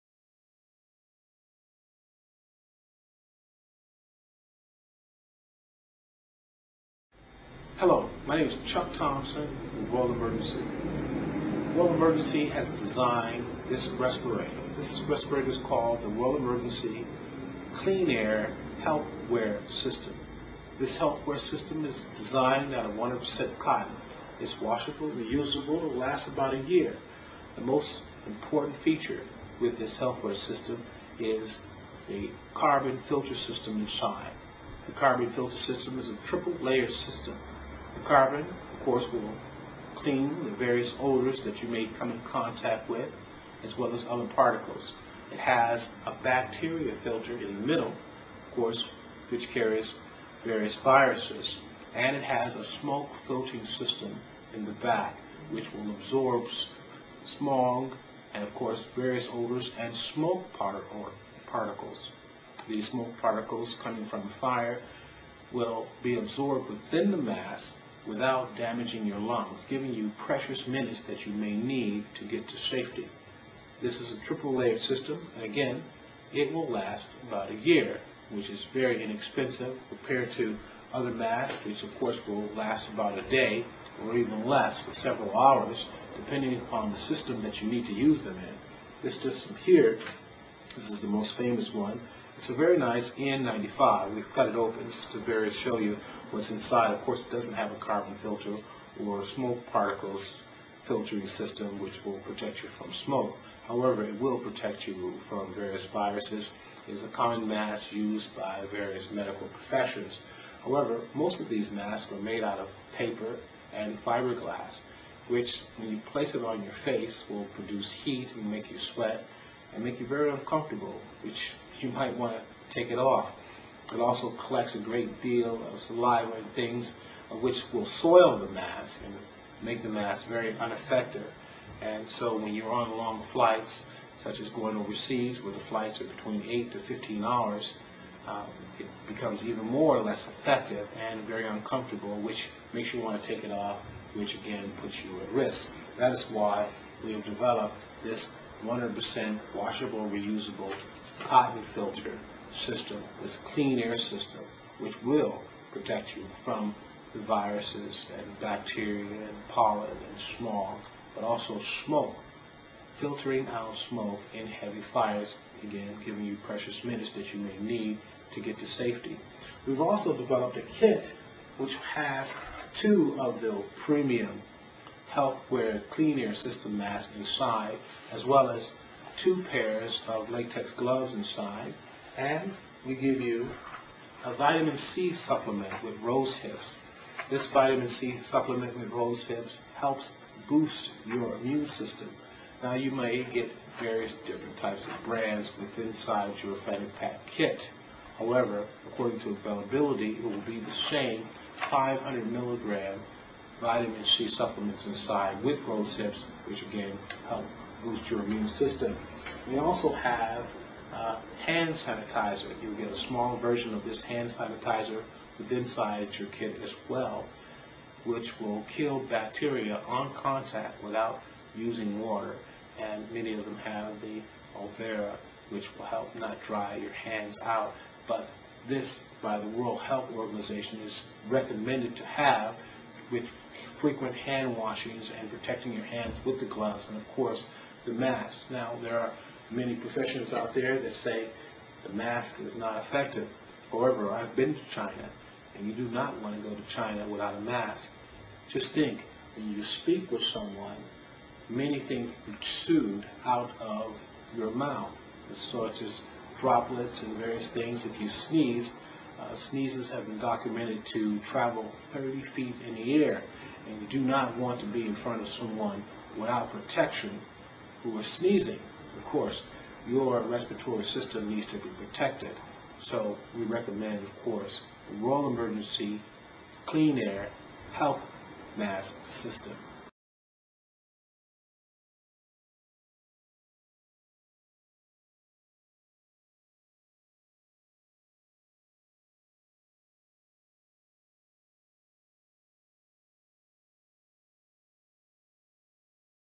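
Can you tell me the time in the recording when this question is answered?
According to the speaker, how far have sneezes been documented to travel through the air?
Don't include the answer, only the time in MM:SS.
04:21.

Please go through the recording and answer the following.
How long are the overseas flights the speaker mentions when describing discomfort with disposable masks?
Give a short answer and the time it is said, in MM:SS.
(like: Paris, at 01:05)
8 to 15 hours, at 02:16.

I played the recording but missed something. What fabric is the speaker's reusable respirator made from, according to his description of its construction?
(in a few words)
100% cotton.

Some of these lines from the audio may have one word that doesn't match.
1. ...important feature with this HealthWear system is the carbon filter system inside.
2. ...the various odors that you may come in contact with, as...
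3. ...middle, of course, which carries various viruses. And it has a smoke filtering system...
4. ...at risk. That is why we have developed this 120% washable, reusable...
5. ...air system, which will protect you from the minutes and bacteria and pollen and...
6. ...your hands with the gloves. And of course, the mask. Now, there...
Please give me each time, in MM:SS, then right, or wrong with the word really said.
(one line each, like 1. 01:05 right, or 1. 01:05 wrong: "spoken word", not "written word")
1. 00:28 right
2. 00:40 right
3. 00:47 right
4. 02:25 wrong: "100", not "120"
5. 02:33 wrong: "viruses", not "minutes"
6. 03:55 right.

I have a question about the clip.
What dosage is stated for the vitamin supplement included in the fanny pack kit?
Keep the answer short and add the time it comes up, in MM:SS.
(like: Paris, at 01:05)
500 milligrams, at 03:21.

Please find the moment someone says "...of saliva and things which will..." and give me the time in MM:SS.
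02:05.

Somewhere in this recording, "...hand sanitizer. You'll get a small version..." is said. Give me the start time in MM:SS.
03:31.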